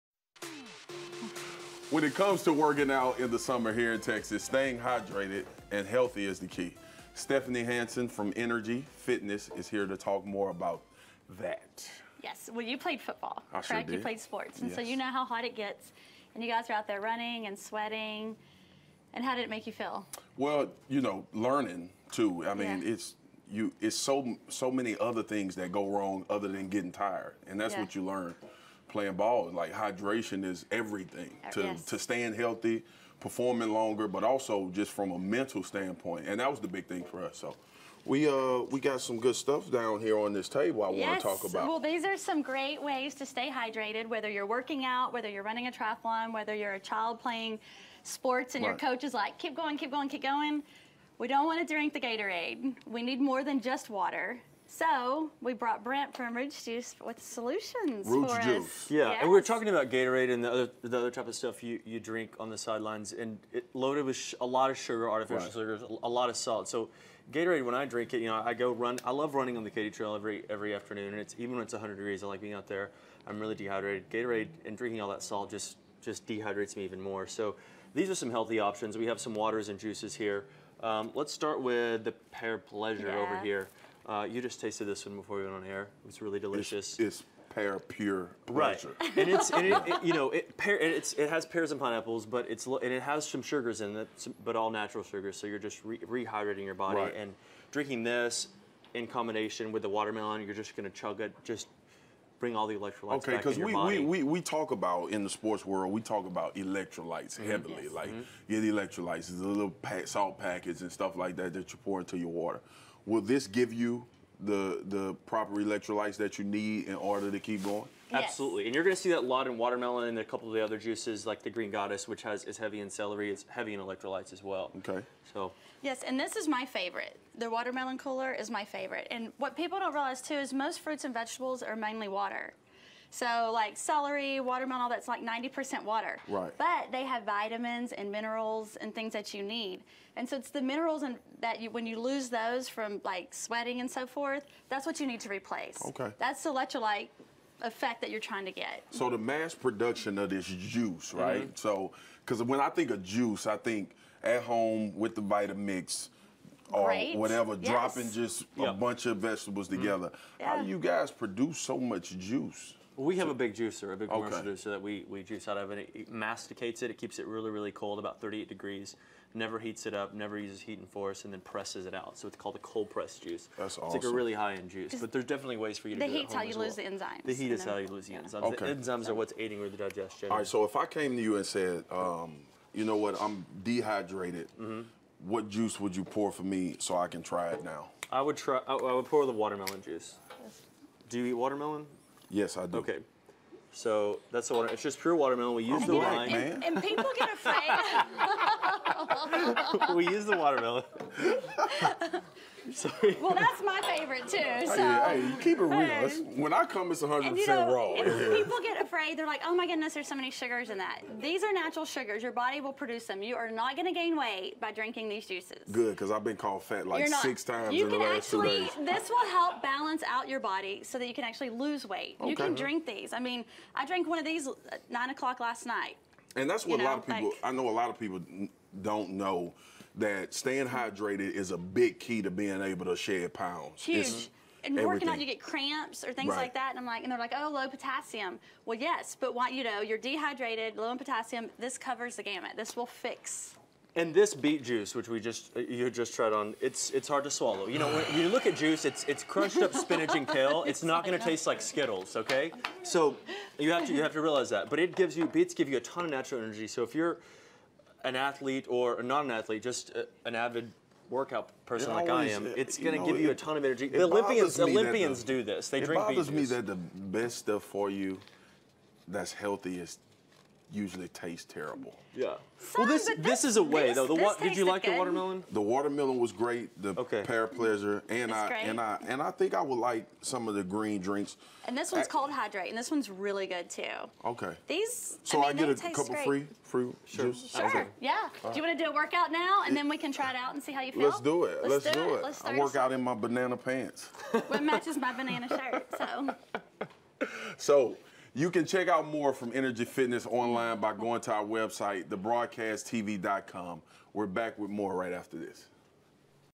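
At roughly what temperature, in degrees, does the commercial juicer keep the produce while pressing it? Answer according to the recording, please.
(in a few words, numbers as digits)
38 degrees.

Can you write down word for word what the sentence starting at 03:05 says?
what juice would you pour for me so I can try it now?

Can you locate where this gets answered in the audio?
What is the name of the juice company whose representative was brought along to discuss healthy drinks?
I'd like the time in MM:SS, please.
00:56.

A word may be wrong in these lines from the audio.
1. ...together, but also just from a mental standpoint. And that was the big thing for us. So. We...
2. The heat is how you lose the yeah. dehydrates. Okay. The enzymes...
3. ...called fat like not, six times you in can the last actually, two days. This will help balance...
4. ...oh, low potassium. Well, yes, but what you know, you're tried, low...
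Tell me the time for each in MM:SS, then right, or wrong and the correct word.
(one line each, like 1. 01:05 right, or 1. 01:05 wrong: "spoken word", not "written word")
1. 00:33 wrong: "longer", not "together"
2. 02:57 wrong: "enzymes", not "dehydrates"
3. 03:36 right
4. 03:57 wrong: "dehydrated", not "tried".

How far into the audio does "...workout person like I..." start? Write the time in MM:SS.
04:21.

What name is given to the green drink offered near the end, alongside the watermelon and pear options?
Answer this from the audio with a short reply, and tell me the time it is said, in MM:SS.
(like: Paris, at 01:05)
Hydrate, at 04:42.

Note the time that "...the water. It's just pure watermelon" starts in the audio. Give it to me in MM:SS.
03:14.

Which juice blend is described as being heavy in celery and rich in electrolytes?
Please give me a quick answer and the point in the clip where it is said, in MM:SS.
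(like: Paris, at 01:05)
Green Goddess, at 02:01.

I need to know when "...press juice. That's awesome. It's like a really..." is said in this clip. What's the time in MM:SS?
02:52.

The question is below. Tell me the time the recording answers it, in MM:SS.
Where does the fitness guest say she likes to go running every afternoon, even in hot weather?
01:09.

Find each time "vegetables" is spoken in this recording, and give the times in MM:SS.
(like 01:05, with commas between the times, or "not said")
02:11, 02:39.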